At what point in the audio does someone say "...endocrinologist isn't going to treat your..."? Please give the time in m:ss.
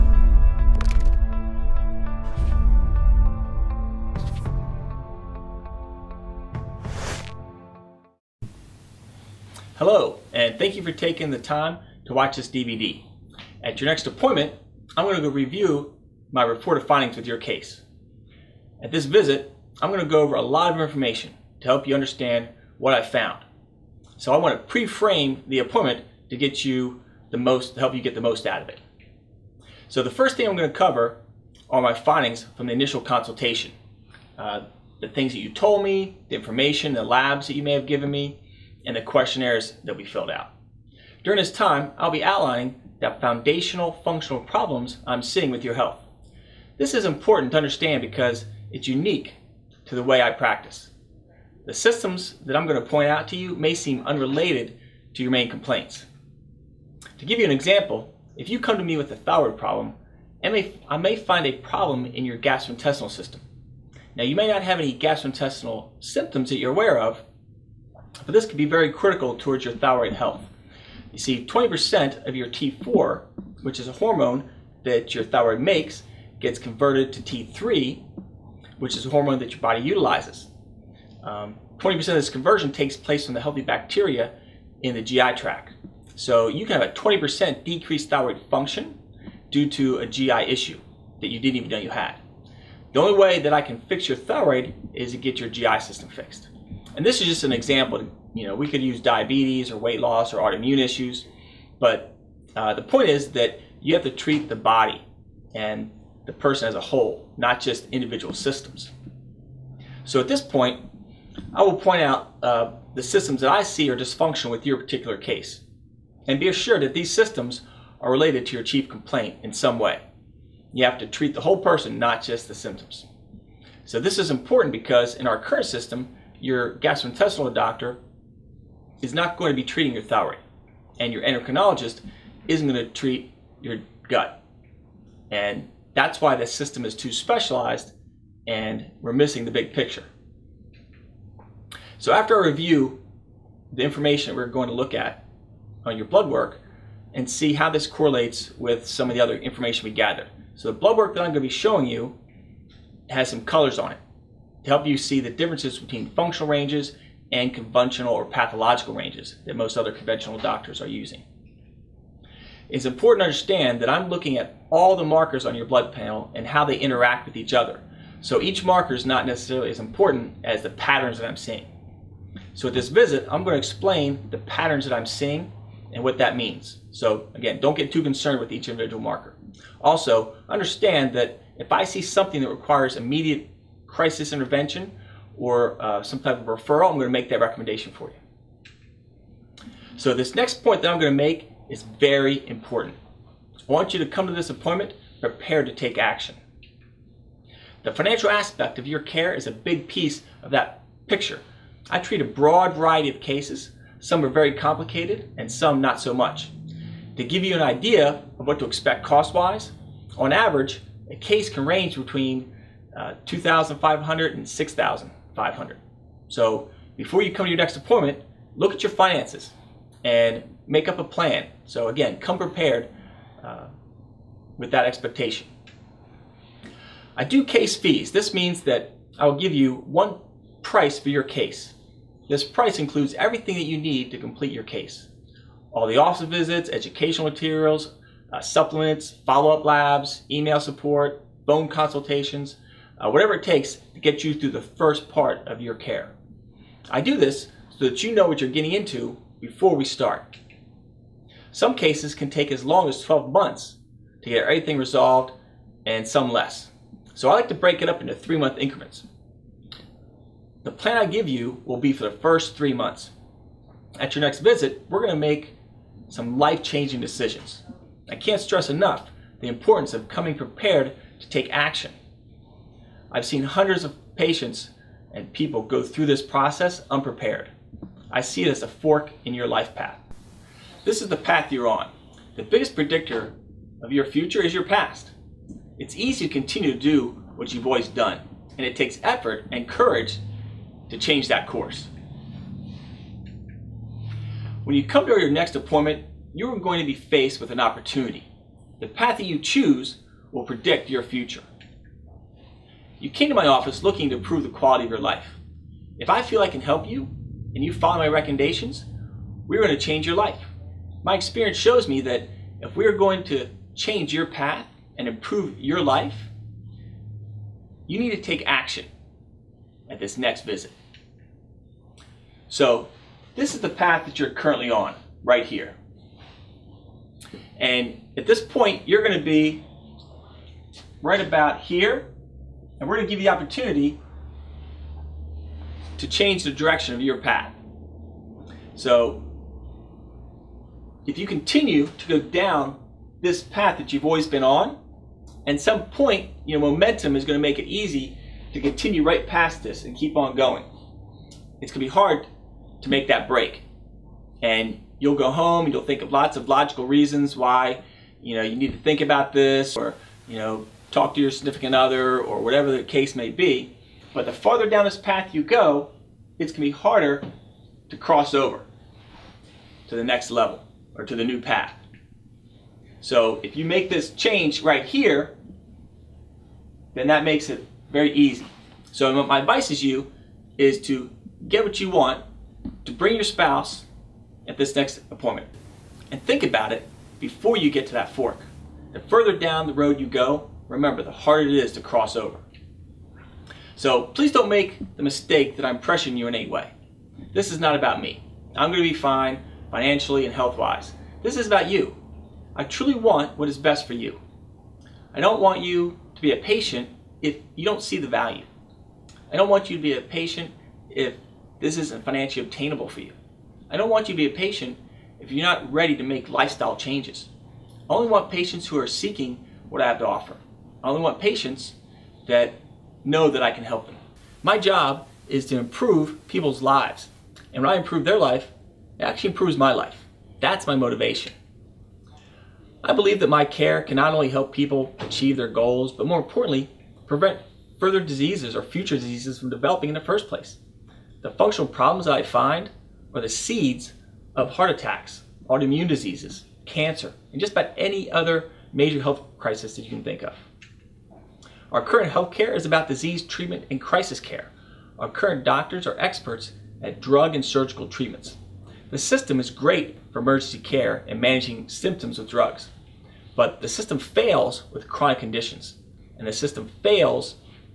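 2:11.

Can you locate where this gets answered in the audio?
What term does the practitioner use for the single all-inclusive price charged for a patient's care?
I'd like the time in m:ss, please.
3:47.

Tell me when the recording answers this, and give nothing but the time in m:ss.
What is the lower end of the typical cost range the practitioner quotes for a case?
3:33.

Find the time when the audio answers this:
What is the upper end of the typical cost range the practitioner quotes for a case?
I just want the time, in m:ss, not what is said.
3:34.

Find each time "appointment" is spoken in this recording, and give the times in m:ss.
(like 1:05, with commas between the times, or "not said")
0:14, 0:25, 3:14, 3:37, 4:55, 6:25.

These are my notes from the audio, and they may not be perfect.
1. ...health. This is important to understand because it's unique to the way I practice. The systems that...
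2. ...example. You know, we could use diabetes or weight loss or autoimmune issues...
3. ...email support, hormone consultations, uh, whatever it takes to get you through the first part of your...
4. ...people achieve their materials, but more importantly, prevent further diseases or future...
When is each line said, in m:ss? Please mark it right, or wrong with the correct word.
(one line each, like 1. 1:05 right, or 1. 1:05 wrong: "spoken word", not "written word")
1. 0:45 right
2. 1:37 right
3. 4:00 wrong: "phone", not "hormone"
4. 7:14 wrong: "goals", not "materials".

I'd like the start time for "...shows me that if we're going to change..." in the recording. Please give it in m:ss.
5:11.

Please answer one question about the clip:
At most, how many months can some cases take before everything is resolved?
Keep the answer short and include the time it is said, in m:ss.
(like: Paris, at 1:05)
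12 months, at 4:13.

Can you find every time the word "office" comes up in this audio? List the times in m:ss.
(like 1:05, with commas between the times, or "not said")
3:55, 5:03.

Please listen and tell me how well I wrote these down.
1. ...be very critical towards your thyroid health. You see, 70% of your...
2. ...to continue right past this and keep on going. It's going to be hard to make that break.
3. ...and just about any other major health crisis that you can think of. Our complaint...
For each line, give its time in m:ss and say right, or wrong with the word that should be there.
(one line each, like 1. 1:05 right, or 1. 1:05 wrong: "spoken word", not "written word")
1. 1:08 wrong: "20", not "70"
2. 5:48 right
3. 7:27 wrong: "current", not "complaint".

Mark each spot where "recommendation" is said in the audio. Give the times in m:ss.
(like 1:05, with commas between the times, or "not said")
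3:07, 5:08.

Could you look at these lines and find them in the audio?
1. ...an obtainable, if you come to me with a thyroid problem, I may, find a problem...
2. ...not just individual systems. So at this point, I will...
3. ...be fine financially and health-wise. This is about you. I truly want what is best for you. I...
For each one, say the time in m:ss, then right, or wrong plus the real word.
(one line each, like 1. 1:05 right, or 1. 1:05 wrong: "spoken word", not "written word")
1. 0:57 wrong: "example", not "obtainable"
2. 1:47 right
3. 6:38 right.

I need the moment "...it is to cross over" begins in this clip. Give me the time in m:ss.
6:31.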